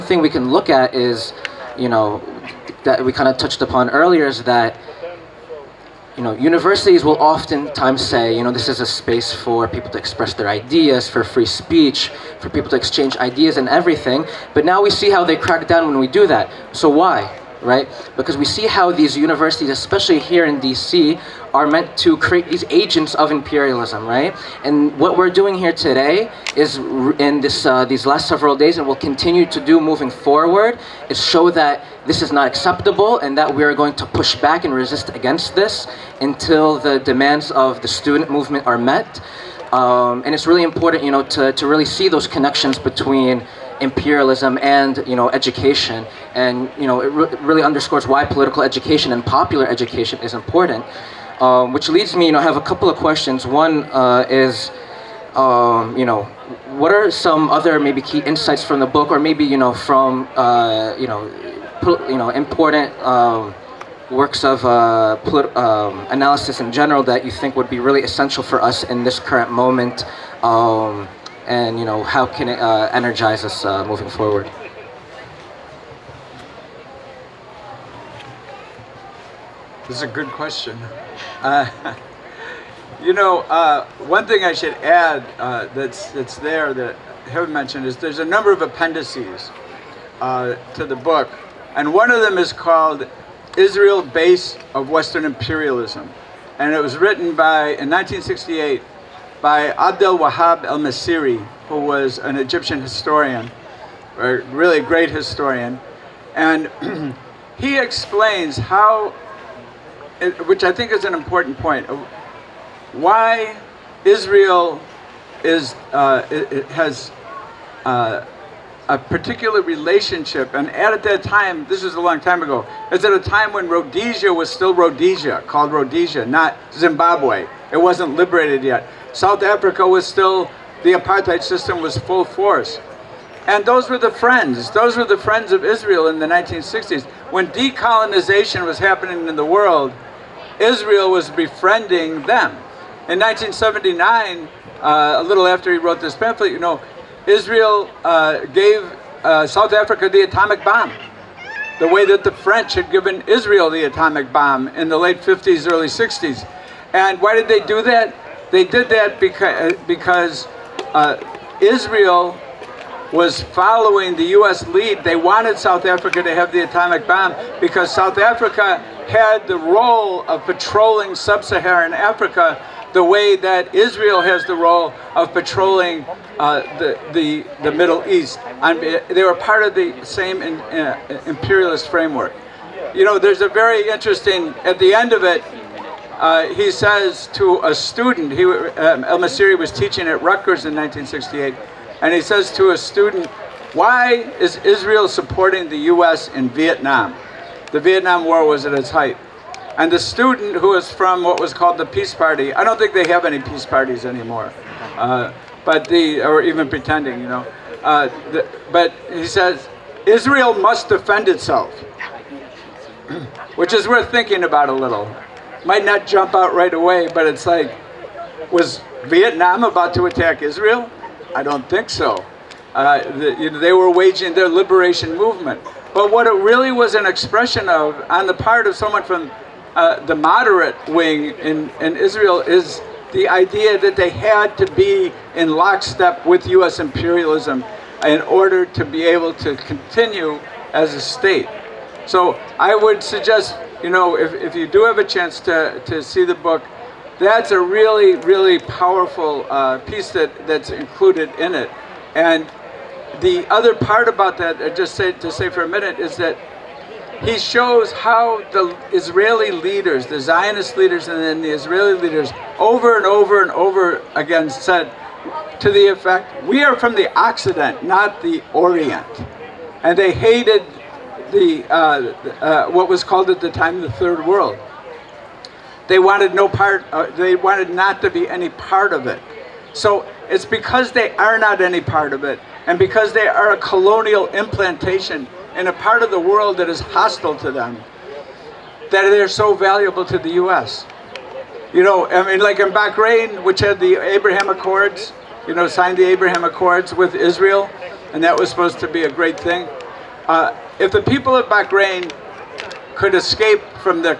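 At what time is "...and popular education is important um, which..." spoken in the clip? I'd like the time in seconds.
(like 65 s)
49 s.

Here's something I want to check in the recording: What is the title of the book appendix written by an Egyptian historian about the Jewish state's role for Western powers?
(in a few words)
Israel Base of Western Imperialism.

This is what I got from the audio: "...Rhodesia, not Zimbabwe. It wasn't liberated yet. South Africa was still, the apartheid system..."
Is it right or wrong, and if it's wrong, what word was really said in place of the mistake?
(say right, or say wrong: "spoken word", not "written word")
right.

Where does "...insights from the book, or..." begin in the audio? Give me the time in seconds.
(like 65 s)
58 s.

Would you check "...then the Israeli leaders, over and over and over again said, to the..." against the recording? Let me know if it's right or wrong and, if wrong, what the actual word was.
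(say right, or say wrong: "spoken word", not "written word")
right.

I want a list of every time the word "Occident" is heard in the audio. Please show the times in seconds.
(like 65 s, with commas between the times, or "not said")
267 s.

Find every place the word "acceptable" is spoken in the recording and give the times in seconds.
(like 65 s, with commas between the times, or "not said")
32 s.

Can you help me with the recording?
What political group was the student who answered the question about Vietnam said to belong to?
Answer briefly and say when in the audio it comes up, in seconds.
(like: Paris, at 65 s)
Peace Party, at 201 s.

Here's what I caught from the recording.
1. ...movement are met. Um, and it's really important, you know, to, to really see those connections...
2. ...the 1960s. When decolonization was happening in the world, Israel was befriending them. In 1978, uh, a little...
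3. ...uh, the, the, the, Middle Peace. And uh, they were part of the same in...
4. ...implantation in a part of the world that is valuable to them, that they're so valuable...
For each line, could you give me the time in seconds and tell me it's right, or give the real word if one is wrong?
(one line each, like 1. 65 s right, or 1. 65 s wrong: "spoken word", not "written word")
1. 38 s right
2. 136 s wrong: "1979", not "1978"
3. 176 s wrong: "East", not "Peace"
4. 284 s wrong: "hostile", not "valuable".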